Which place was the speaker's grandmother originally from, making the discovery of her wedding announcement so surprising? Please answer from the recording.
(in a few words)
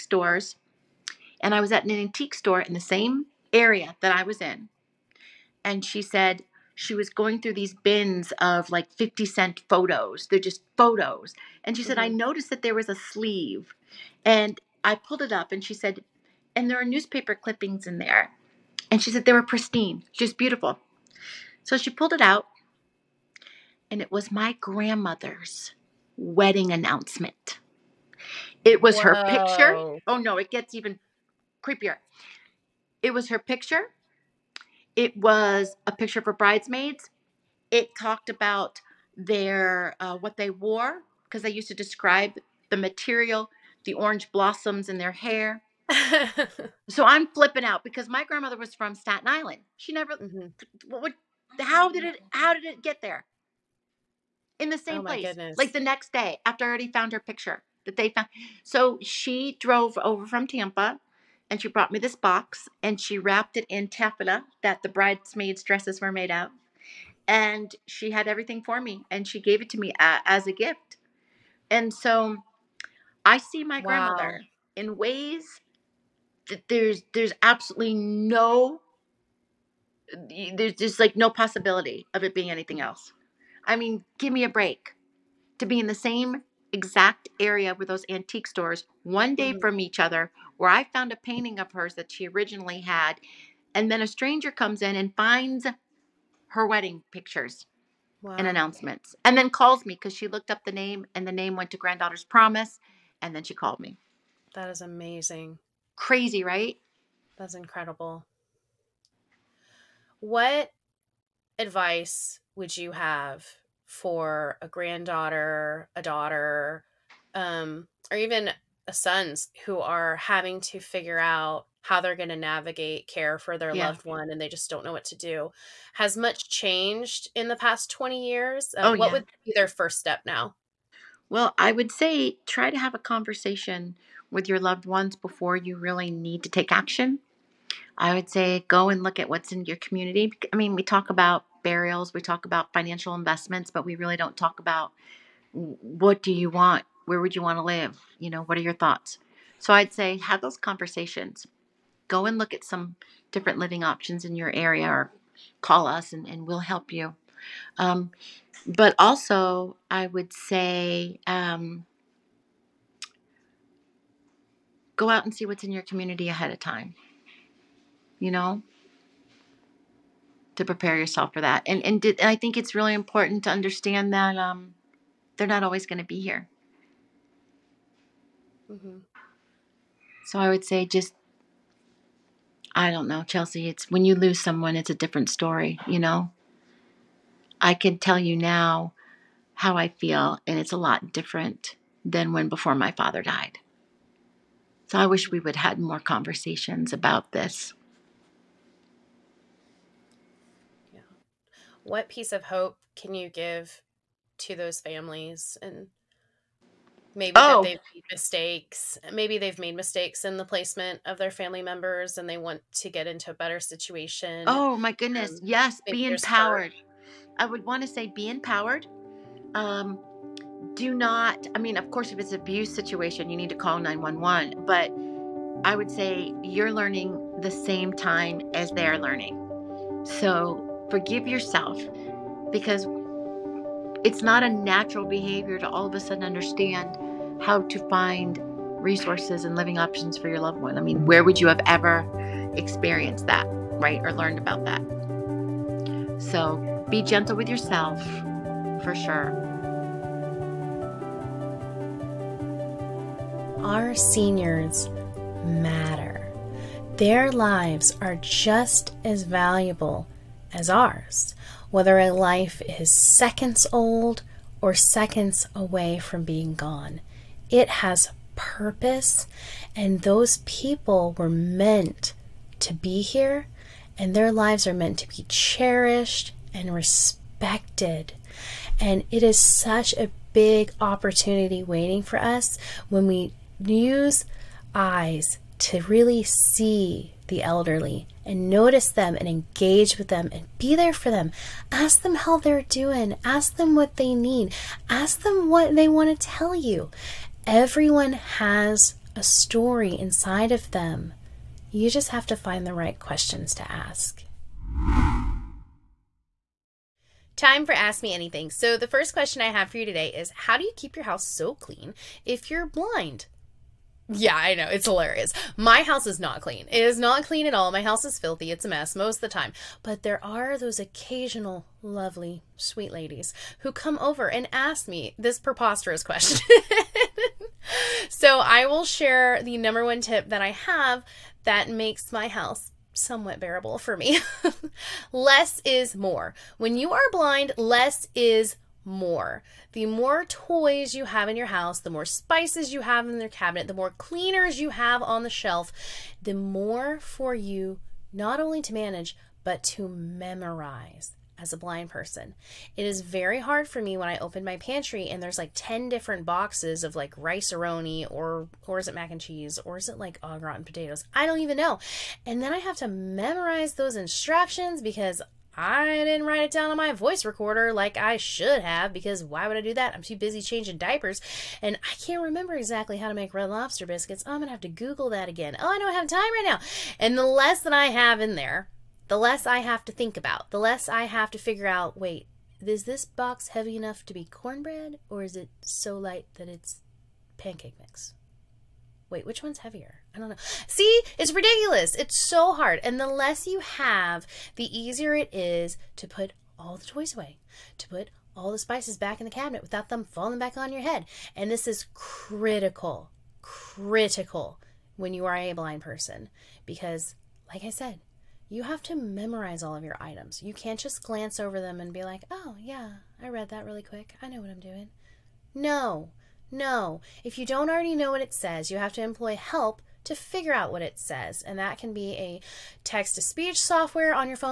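Staten Island.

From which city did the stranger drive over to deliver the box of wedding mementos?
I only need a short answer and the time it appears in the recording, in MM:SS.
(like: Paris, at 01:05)
Tampa, at 01:00.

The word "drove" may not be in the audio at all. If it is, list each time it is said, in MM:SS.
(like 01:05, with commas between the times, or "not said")
00:59.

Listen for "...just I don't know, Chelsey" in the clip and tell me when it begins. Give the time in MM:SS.
03:00.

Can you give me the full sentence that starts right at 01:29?
from each other, where I found a painting of hers that she originally had.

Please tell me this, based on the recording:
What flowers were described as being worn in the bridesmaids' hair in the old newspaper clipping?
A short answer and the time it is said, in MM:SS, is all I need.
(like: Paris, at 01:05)
Orange blossoms, at 00:43.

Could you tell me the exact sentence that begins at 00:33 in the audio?
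It was her picture it was a picture for bridesmaids.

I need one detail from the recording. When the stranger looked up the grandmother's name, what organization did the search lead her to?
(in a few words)
Granddaughter's Promise.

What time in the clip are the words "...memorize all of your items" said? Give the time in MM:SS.
06:48.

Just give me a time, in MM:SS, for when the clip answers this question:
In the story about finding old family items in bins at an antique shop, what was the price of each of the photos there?
00:08.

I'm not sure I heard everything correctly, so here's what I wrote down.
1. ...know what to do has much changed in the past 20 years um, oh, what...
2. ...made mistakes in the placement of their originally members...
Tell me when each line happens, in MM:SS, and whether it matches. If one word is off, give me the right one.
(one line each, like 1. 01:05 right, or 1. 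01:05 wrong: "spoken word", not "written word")
1. 02:04 right
2. 03:29 wrong: "family", not "originally".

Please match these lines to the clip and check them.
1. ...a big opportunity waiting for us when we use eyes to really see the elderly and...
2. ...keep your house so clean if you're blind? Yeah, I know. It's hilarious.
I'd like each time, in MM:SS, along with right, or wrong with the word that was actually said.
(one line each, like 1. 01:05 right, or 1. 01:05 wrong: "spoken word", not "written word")
1. 04:39 right
2. 05:10 right.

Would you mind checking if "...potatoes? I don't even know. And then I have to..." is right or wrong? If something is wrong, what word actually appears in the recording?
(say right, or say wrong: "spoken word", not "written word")
right.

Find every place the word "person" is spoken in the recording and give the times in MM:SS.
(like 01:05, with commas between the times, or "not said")
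05:51, 06:45.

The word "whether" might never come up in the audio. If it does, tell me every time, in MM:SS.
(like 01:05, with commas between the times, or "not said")
04:21.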